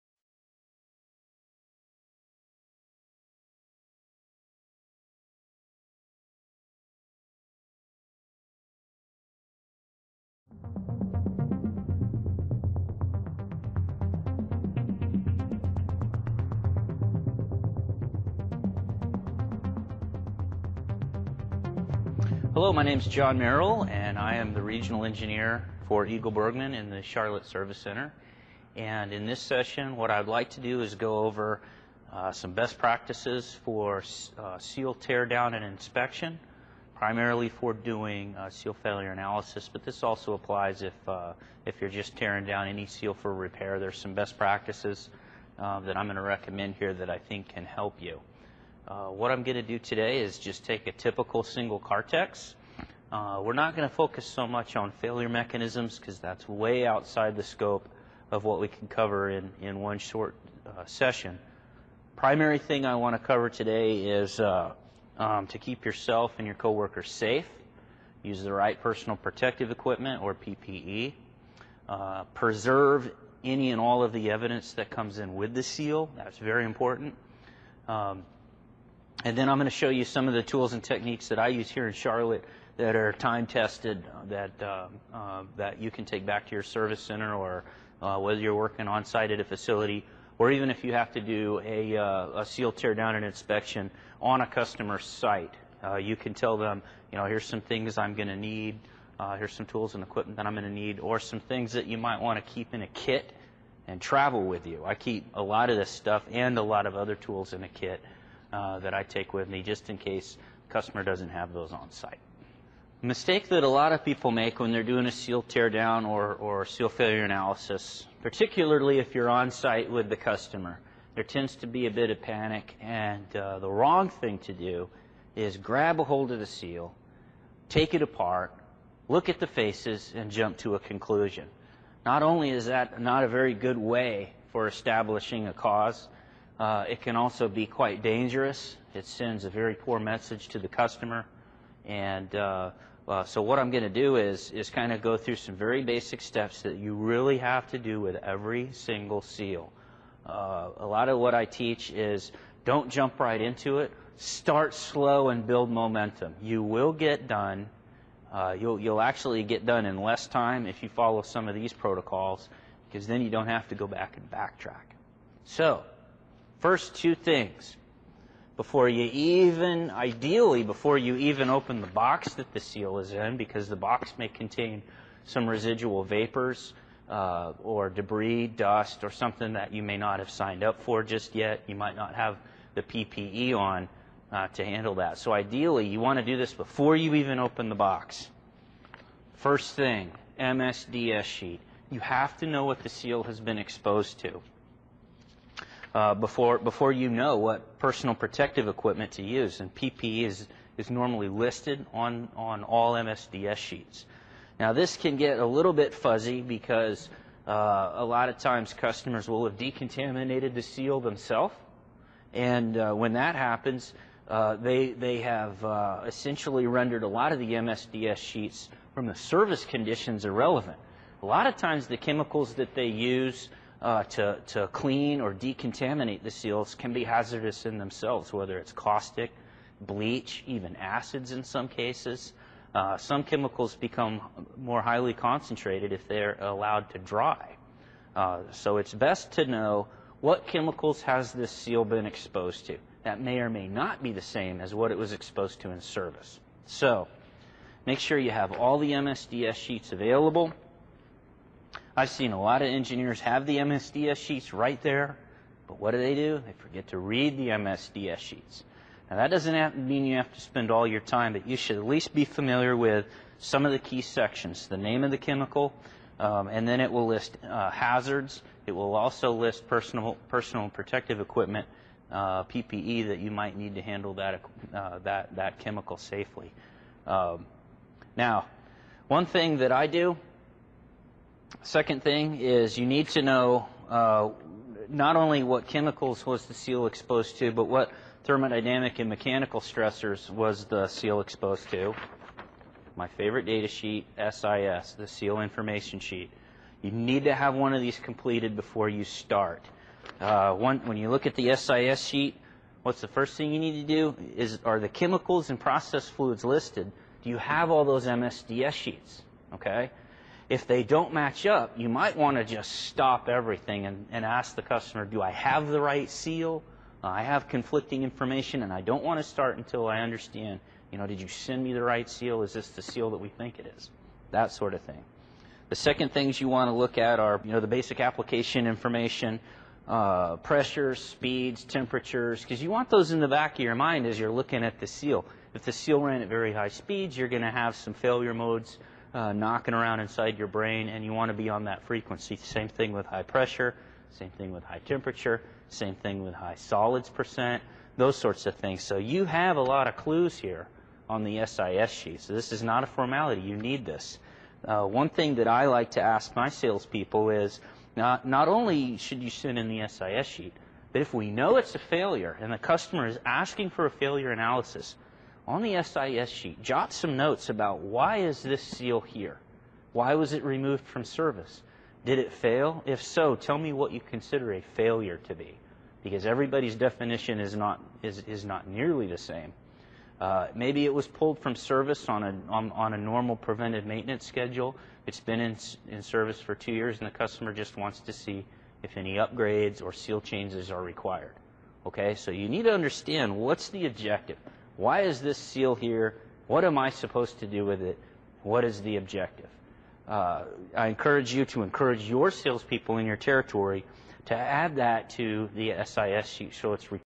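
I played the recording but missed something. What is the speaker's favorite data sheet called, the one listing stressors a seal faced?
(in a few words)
seal information sheet.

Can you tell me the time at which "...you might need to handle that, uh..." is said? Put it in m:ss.
4:33.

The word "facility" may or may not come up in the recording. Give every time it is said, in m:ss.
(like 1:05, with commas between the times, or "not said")
1:29.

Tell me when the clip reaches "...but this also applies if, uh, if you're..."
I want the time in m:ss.
0:39.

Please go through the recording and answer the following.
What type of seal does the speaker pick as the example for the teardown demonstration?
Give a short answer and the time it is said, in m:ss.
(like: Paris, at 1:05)
single Cartex, at 0:51.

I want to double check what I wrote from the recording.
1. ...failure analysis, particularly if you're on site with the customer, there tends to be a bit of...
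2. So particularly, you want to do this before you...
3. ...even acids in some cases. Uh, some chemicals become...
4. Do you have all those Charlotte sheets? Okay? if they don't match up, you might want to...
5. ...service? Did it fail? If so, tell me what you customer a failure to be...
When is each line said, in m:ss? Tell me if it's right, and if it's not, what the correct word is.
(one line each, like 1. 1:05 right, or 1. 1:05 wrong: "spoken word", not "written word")
1. 1:56 right
2. 3:05 wrong: "ideally", not "particularly"
3. 3:50 right
4. 5:07 wrong: "MSDS", not "Charlotte"
5. 6:11 wrong: "consider", not "customer".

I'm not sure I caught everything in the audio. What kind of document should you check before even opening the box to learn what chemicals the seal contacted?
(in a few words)
MSDS sheet.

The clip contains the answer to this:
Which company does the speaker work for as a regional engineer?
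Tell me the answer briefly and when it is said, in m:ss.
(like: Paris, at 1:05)
EagleBurgmann, at 0:26.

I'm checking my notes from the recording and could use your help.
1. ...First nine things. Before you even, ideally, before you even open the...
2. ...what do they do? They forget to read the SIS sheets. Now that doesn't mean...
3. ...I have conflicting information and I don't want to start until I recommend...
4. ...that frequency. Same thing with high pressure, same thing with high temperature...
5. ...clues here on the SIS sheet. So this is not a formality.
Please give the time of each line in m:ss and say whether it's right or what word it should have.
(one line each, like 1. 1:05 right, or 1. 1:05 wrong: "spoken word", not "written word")
1. 2:46 wrong: "two", not "nine"
2. 4:15 wrong: "MSDS", not "SIS"
3. 5:17 wrong: "understand", not "recommend"
4. 5:41 right
5. 5:49 right.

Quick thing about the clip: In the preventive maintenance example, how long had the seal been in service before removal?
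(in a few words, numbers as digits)
2 years.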